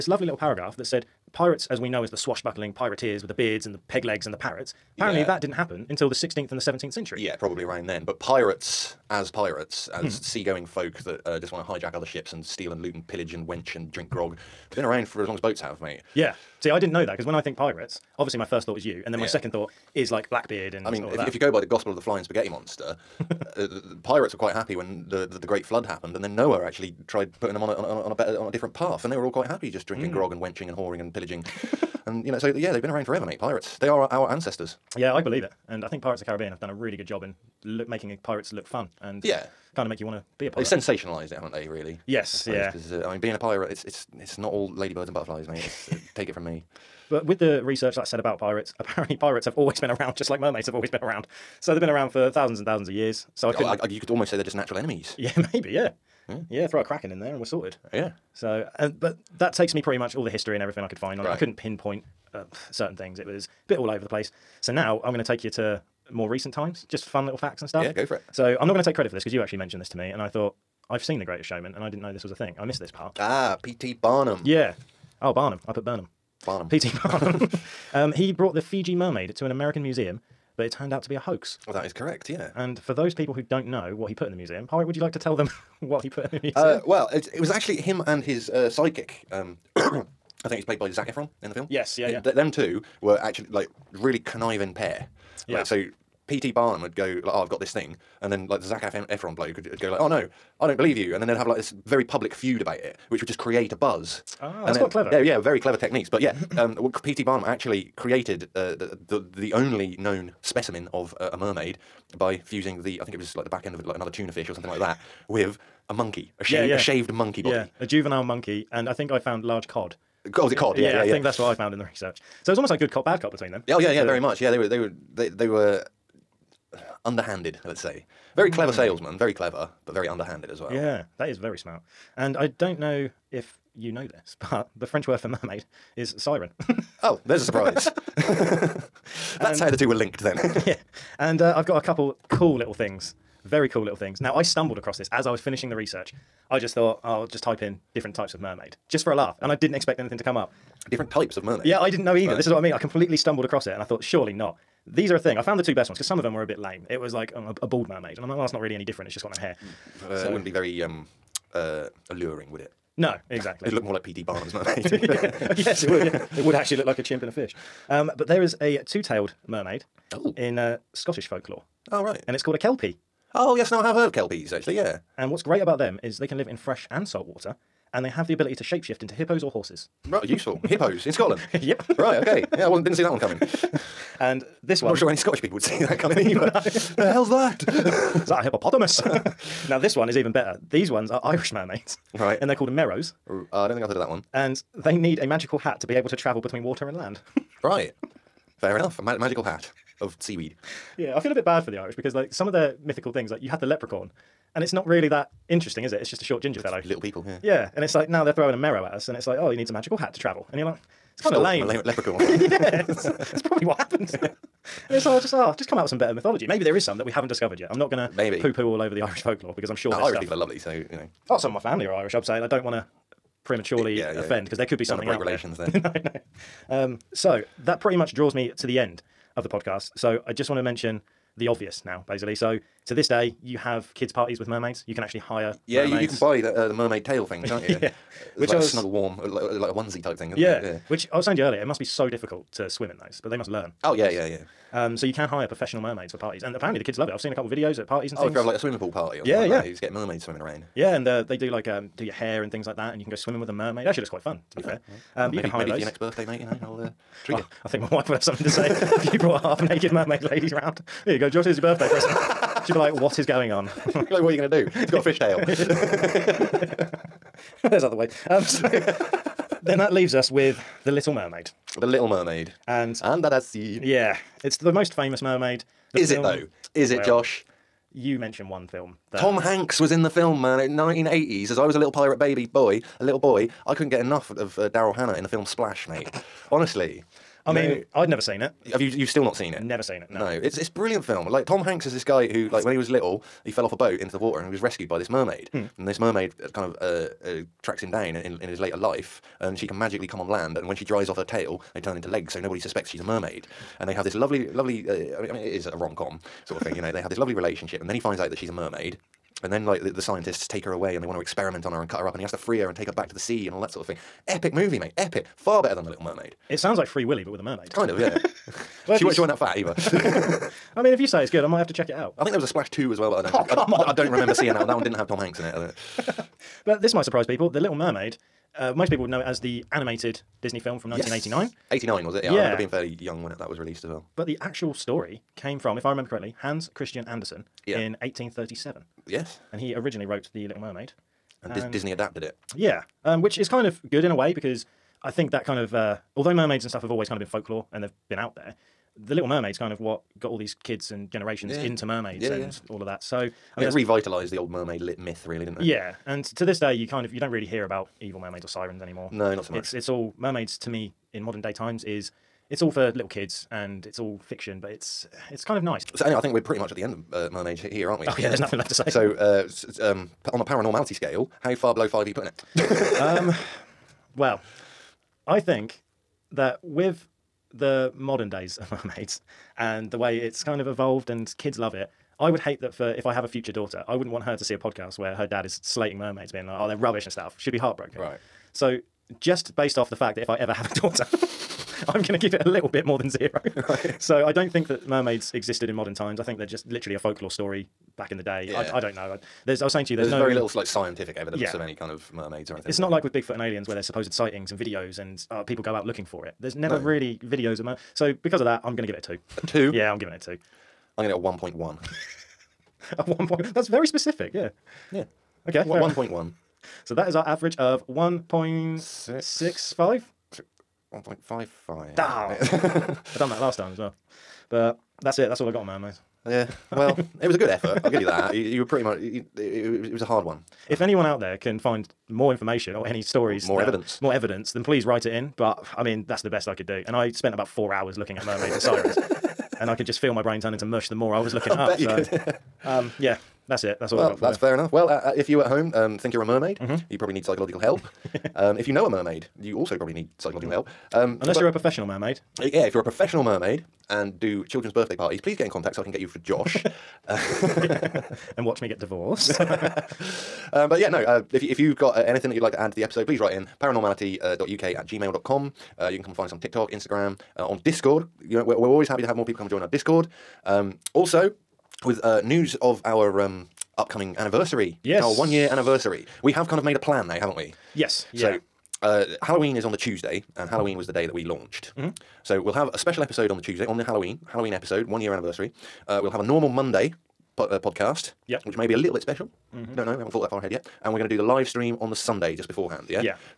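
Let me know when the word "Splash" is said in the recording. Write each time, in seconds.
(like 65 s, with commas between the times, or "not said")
285 s, 322 s.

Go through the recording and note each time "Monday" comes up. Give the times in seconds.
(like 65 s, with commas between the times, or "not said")
486 s.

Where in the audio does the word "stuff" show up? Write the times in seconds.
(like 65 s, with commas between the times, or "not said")
67 s, 220 s, 346 s, 387 s.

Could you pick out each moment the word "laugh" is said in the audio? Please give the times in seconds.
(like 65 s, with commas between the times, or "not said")
149 s.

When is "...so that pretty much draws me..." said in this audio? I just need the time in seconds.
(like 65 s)
227 s.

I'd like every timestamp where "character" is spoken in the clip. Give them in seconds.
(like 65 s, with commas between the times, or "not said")
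not said.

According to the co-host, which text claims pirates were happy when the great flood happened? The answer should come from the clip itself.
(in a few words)
Gospel of the Flying Spaghetti Monster.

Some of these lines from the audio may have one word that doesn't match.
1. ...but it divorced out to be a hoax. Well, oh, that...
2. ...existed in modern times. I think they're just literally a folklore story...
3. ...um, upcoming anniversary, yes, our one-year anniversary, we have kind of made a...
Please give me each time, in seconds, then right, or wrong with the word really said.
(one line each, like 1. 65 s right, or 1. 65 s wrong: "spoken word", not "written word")
1. 80 s wrong: "turned", not "divorced"
2. 395 s right
3. 473 s right.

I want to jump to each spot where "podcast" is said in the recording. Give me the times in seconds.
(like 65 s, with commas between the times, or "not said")
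229 s, 384 s, 487 s.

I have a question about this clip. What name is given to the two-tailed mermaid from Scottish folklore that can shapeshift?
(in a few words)
Kelpie.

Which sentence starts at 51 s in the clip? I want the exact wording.
So they've been around for thousands and thousands of years.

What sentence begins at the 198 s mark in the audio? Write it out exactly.
A ma- magical hat of seaweed.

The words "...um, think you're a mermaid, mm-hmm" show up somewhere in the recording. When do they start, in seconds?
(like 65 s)
445 s.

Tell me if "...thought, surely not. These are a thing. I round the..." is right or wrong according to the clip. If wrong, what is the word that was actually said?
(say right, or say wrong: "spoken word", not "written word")
wrong: "found", not "round".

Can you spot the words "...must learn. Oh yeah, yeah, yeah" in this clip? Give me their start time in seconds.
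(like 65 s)
243 s.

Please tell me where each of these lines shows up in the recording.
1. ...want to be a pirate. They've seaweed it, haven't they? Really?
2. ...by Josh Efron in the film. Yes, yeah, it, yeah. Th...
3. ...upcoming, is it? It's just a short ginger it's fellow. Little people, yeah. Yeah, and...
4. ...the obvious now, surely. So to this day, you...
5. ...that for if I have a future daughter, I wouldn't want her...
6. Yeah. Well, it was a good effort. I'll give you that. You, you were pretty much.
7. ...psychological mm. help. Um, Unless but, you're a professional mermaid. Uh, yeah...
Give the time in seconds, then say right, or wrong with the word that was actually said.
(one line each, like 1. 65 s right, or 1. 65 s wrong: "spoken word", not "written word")
1. 40 s wrong: "sensationalised", not "seaweed"
2. 90 s wrong: "Zac", not "Josh"
3. 205 s wrong: "interesting", not "upcoming"
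4. 231 s wrong: "basically", not "surely"
5. 382 s right
6. 426 s right
7. 450 s right.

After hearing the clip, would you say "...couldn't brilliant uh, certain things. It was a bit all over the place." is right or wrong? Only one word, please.
wrong.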